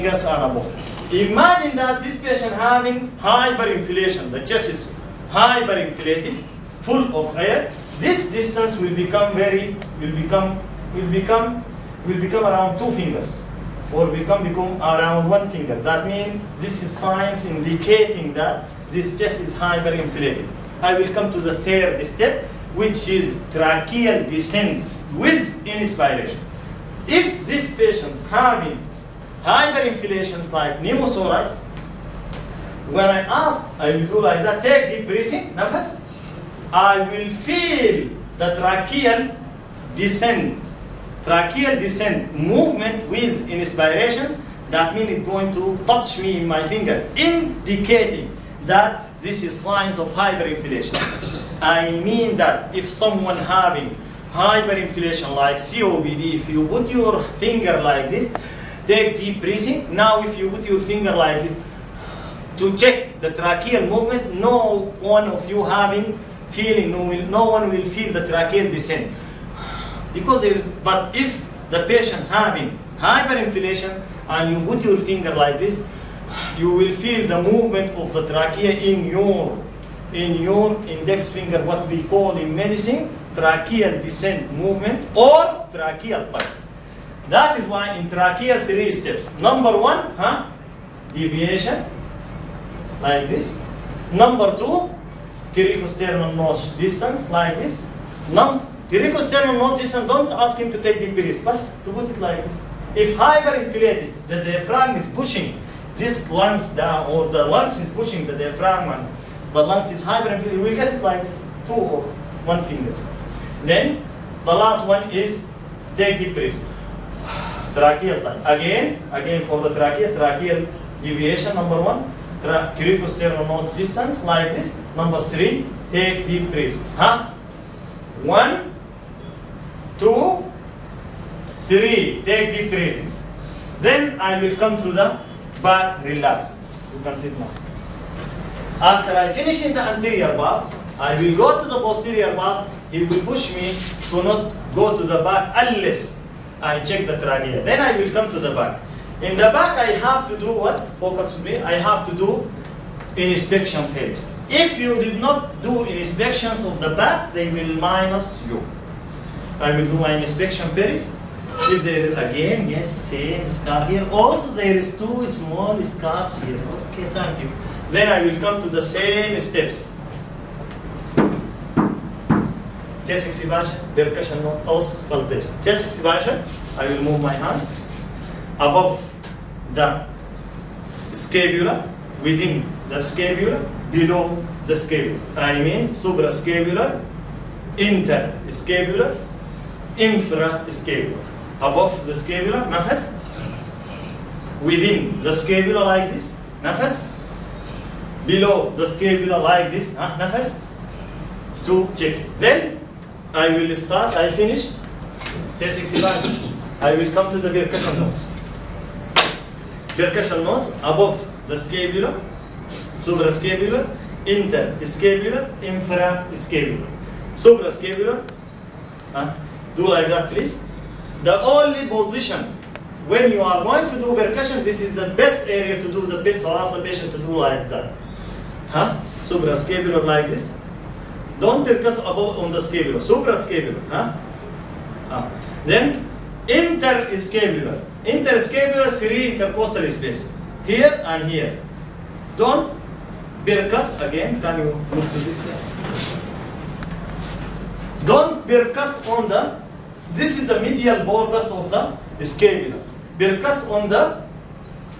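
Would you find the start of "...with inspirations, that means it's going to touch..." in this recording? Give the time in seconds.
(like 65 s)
43 s.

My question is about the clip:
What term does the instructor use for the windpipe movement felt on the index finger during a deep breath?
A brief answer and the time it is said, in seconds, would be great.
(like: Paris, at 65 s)
tracheal pipe, at 85 s.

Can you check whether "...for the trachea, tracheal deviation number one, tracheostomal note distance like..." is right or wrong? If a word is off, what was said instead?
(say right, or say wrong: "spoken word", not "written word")
right.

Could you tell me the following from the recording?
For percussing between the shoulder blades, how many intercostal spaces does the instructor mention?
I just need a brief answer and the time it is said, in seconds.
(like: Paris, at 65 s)
3, at 238 s.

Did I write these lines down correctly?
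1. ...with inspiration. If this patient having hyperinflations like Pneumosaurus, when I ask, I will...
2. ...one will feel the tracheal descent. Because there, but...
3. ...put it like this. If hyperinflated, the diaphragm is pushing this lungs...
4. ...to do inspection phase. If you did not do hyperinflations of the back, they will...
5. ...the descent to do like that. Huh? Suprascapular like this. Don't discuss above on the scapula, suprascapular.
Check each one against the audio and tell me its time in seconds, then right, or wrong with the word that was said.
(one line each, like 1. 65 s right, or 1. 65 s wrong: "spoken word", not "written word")
1. 25 s right
2. 67 s right
3. 101 s right
4. 152 s wrong: "inspections", not "hyperinflations"
5. 226 s wrong: "patient", not "descent".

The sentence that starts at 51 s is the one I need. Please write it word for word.
I mean that if someone having hyperinflation like COPD, if you put your finger like this, Take deep breathing.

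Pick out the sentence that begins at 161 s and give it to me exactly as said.
If there is again, yes, same scar here.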